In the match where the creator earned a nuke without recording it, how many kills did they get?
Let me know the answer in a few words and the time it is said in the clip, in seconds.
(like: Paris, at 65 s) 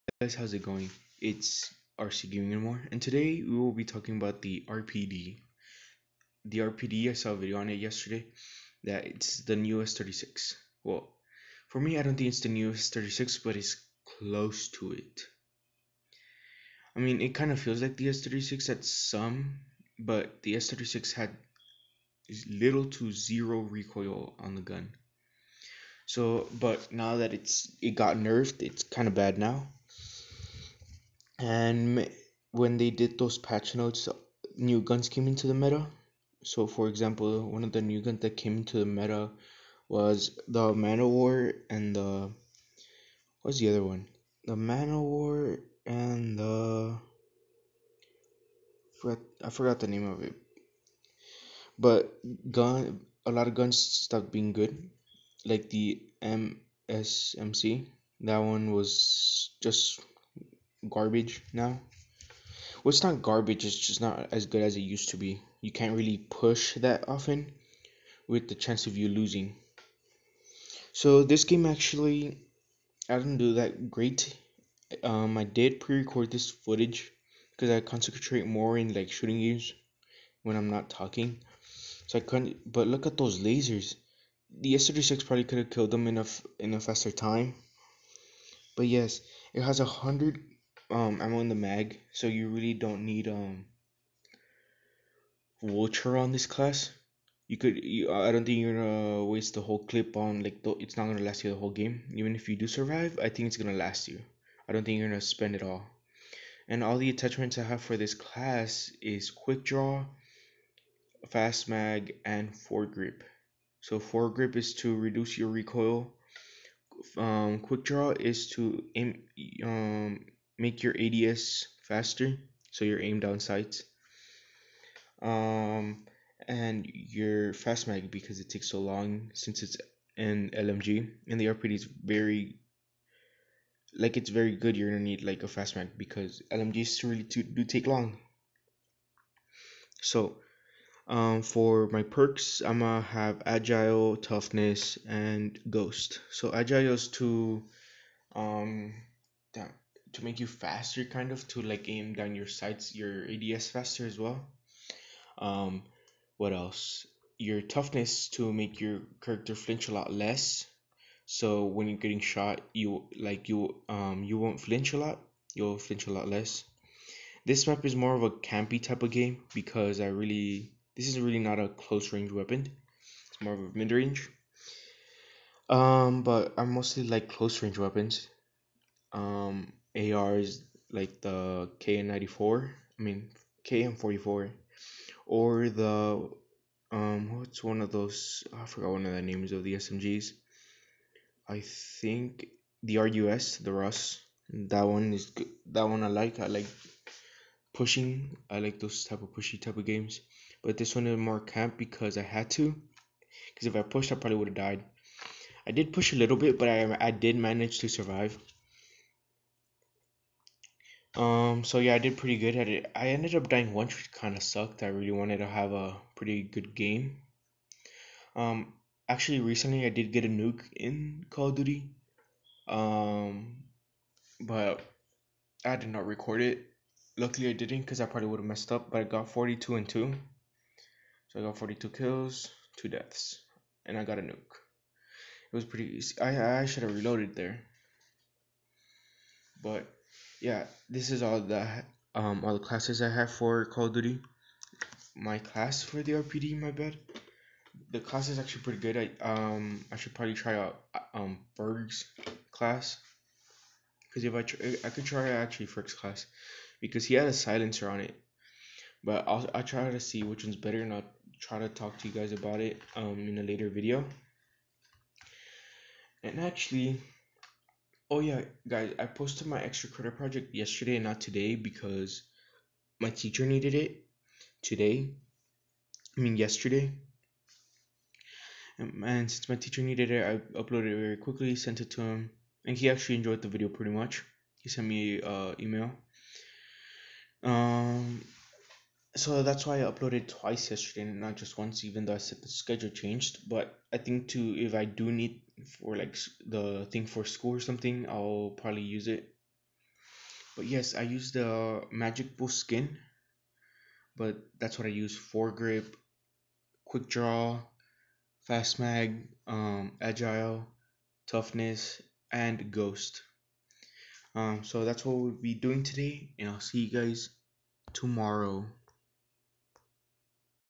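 42, at 231 s.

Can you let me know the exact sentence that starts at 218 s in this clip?
Um, actually, recently I did get a nuke in Call of Duty.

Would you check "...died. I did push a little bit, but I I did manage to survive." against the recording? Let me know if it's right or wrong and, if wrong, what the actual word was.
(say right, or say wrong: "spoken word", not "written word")
right.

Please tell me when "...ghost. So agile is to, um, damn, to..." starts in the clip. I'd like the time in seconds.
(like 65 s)
145 s.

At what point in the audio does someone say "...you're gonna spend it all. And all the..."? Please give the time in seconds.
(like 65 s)
104 s.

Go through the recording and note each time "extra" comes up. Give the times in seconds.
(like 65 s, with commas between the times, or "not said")
269 s.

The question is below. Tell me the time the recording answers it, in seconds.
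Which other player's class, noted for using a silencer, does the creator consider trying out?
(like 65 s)
255 s.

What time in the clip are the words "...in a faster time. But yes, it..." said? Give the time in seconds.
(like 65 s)
86 s.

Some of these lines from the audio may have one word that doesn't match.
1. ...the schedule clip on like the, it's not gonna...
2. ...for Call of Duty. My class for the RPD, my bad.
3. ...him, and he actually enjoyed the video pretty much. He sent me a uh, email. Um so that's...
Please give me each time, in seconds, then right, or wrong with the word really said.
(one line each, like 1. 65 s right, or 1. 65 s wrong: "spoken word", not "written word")
1. 99 s wrong: "whole", not "schedule"
2. 243 s right
3. 282 s right.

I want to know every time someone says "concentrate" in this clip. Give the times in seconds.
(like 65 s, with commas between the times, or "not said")
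77 s.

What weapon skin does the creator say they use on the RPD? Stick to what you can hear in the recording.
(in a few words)
Magic Boost.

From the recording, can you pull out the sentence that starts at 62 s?
Well, it's not garbage, it's just not as good as it used to be.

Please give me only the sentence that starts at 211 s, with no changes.
Um, so yeah, I did pretty good at it.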